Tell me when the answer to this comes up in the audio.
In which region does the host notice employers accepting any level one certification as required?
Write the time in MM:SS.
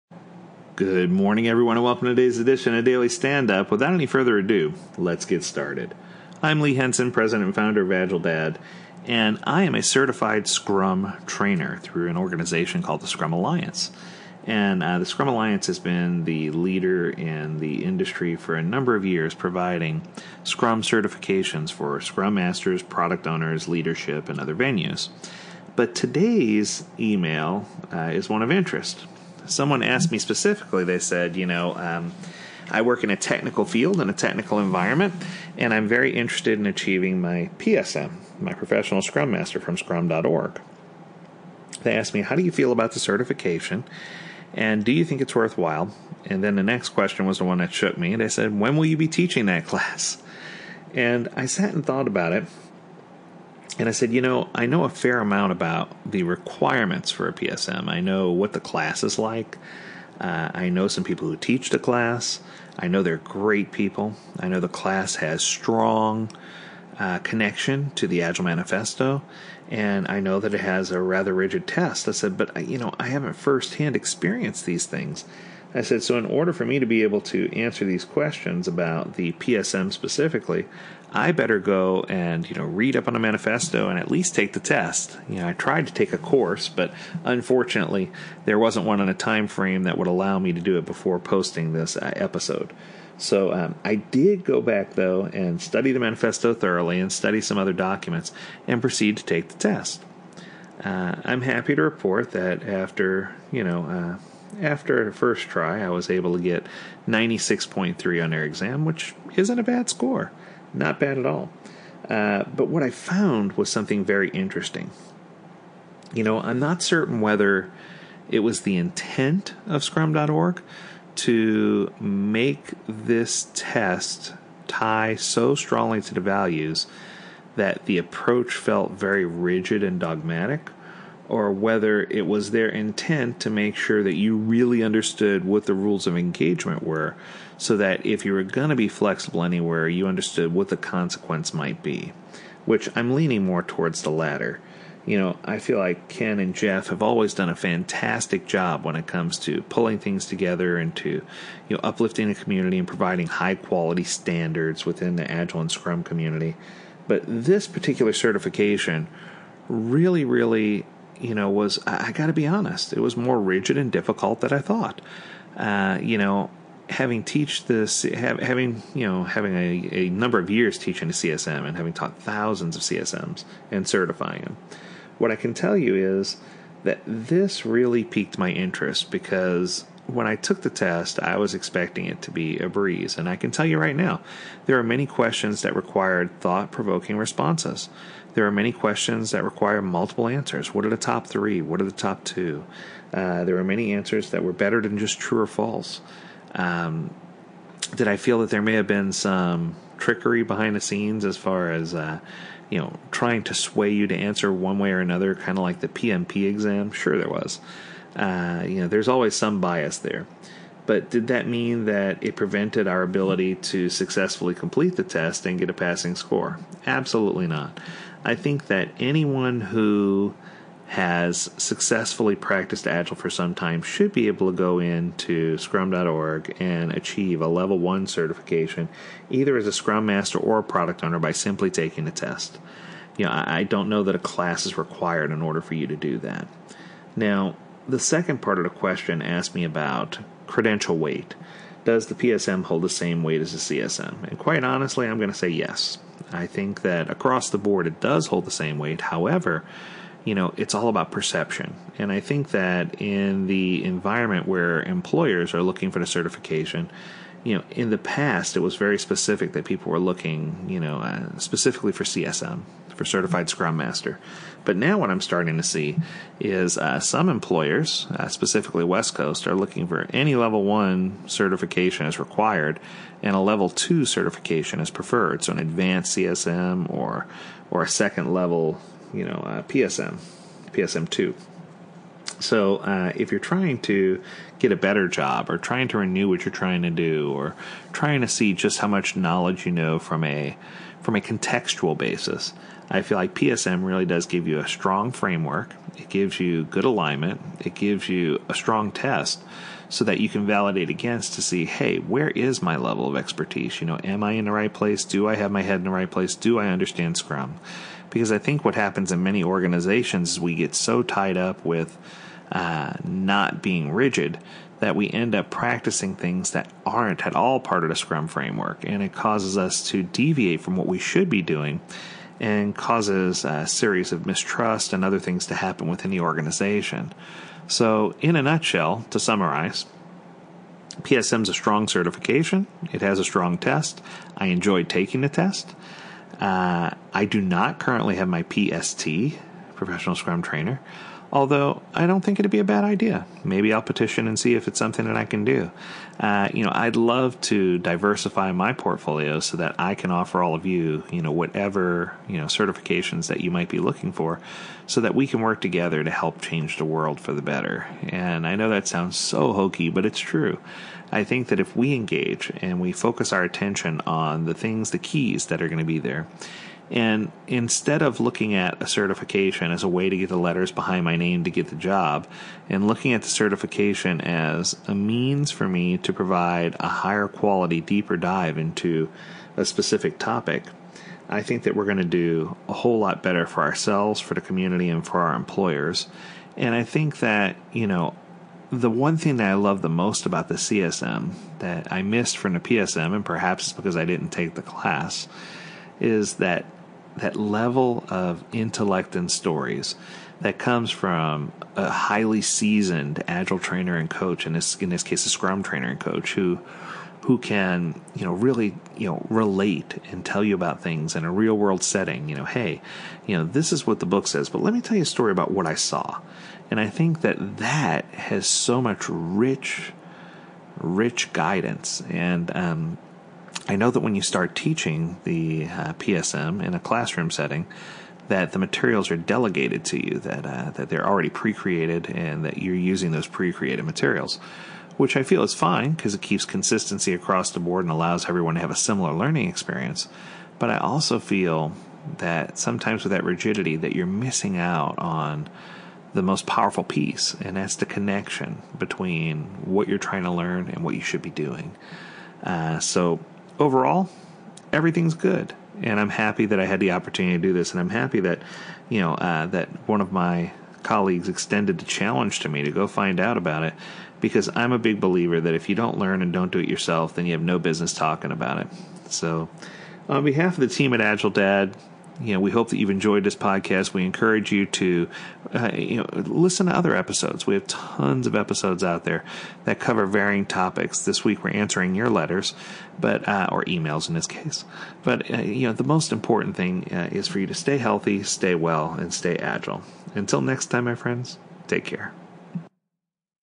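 04:28.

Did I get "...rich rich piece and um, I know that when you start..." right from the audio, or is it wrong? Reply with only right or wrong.
wrong.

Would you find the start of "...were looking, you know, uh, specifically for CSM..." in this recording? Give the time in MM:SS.
04:19.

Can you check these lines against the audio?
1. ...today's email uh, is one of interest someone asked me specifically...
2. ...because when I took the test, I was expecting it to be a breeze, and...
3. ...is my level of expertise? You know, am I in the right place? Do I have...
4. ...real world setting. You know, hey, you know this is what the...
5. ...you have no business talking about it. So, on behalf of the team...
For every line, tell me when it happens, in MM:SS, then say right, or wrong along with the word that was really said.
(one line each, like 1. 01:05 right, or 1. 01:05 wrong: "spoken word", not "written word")
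1. 00:25 right
2. 02:59 right
3. 05:02 right
4. 06:51 right
5. 07:47 right.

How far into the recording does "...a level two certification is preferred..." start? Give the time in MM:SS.
04:33.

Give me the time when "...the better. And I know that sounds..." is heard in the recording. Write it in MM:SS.
05:57.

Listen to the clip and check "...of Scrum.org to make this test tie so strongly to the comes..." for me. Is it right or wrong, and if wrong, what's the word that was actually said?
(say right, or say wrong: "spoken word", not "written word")
wrong: "values", not "comes".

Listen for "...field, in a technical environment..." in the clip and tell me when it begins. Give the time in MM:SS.
00:33.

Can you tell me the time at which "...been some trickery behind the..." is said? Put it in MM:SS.
03:18.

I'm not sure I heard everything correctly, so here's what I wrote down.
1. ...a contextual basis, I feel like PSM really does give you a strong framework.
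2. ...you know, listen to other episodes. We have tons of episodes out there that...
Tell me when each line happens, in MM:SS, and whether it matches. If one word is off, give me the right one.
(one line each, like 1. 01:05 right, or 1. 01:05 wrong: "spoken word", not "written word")
1. 04:51 right
2. 07:55 right.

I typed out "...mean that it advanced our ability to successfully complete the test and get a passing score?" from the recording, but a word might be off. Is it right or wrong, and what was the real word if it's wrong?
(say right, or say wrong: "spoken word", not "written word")
wrong: "prevented", not "advanced".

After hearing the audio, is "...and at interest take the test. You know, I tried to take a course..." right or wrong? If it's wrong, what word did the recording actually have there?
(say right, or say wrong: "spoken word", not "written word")
wrong: "least", not "interest".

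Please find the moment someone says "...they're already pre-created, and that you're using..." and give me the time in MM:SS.
07:10.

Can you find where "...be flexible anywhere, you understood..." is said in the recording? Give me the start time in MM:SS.
02:18.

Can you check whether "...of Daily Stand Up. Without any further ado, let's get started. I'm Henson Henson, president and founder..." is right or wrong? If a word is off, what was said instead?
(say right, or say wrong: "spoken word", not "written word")
wrong: "Lee", not "Henson".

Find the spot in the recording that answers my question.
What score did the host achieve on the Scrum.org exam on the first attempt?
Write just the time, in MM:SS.
01:47.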